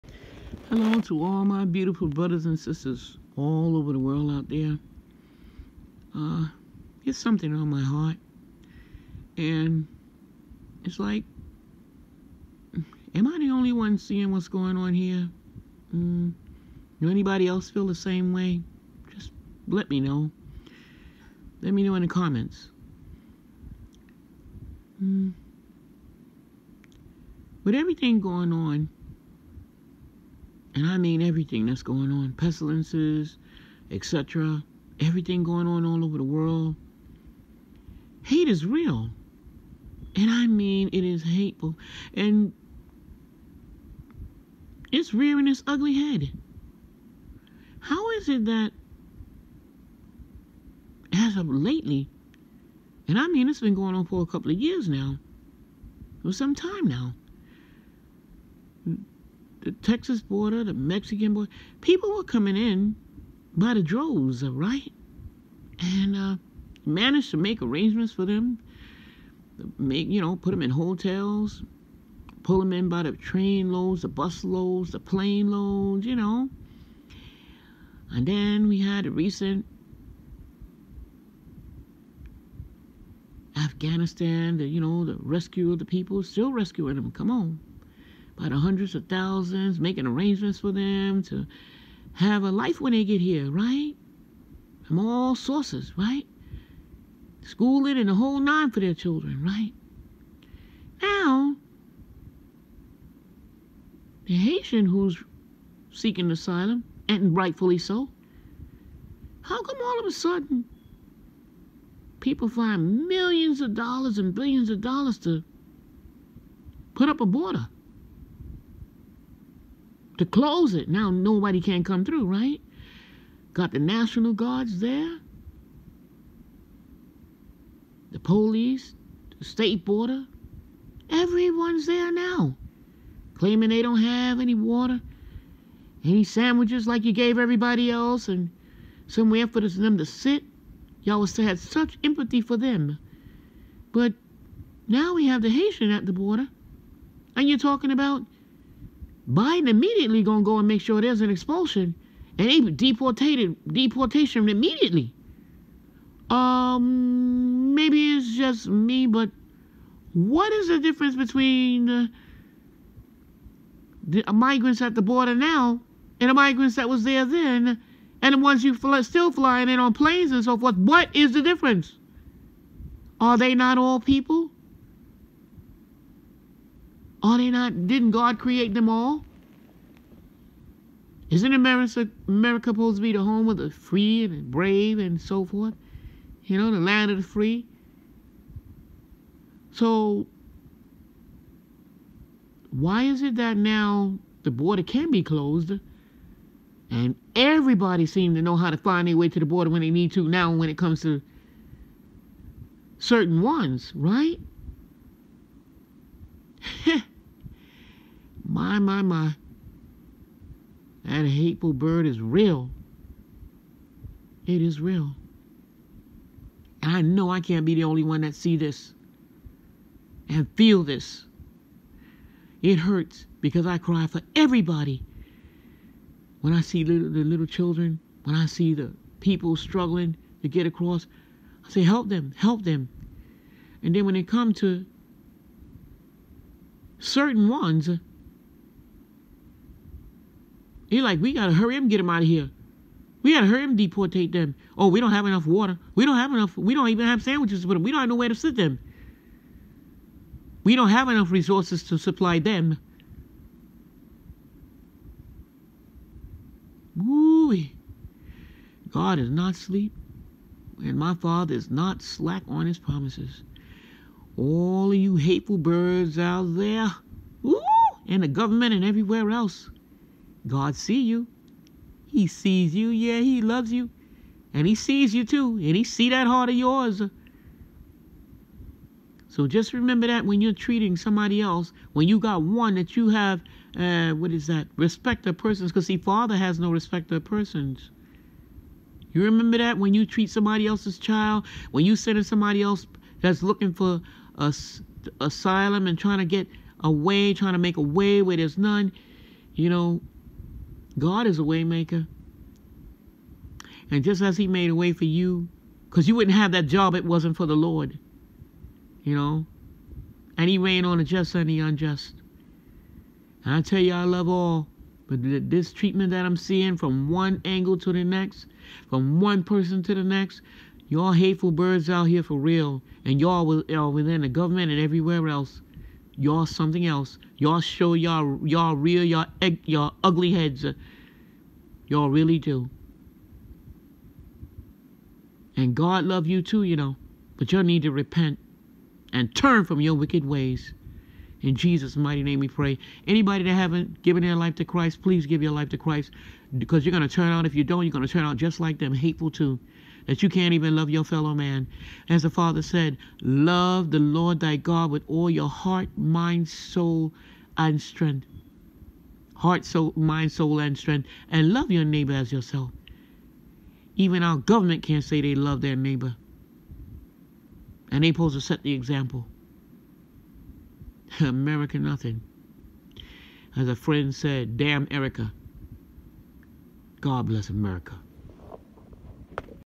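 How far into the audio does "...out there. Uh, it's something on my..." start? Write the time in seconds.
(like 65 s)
4 s.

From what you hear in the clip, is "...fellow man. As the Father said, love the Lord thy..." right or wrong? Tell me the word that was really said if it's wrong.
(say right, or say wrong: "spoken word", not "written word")
right.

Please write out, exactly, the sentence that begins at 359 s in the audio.
Heart, soul, mind, soul, and strength.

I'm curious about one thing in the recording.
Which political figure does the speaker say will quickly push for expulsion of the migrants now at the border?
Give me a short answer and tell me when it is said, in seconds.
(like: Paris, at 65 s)
Biden, at 149 s.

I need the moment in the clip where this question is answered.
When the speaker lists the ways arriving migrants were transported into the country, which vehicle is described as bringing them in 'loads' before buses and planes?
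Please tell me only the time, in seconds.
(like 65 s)
73 s.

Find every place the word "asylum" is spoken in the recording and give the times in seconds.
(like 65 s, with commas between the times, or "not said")
106 s, 295 s.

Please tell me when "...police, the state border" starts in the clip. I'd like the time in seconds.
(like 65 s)
128 s.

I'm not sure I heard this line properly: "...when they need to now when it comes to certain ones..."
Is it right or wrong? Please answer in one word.
right.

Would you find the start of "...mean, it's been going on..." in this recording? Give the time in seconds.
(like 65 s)
53 s.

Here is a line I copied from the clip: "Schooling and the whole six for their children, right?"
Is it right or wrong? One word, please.
wrong.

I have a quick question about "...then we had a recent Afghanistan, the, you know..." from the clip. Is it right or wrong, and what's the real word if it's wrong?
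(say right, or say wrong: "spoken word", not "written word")
right.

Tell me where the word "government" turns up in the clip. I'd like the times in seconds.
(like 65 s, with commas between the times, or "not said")
268 s, 324 s, 364 s.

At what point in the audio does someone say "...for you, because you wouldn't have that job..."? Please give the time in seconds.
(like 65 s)
304 s.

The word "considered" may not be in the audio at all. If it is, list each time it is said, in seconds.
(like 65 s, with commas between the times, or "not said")
not said.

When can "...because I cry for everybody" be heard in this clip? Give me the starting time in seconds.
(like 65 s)
223 s.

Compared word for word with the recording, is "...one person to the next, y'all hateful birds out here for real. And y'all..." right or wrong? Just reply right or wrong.
right.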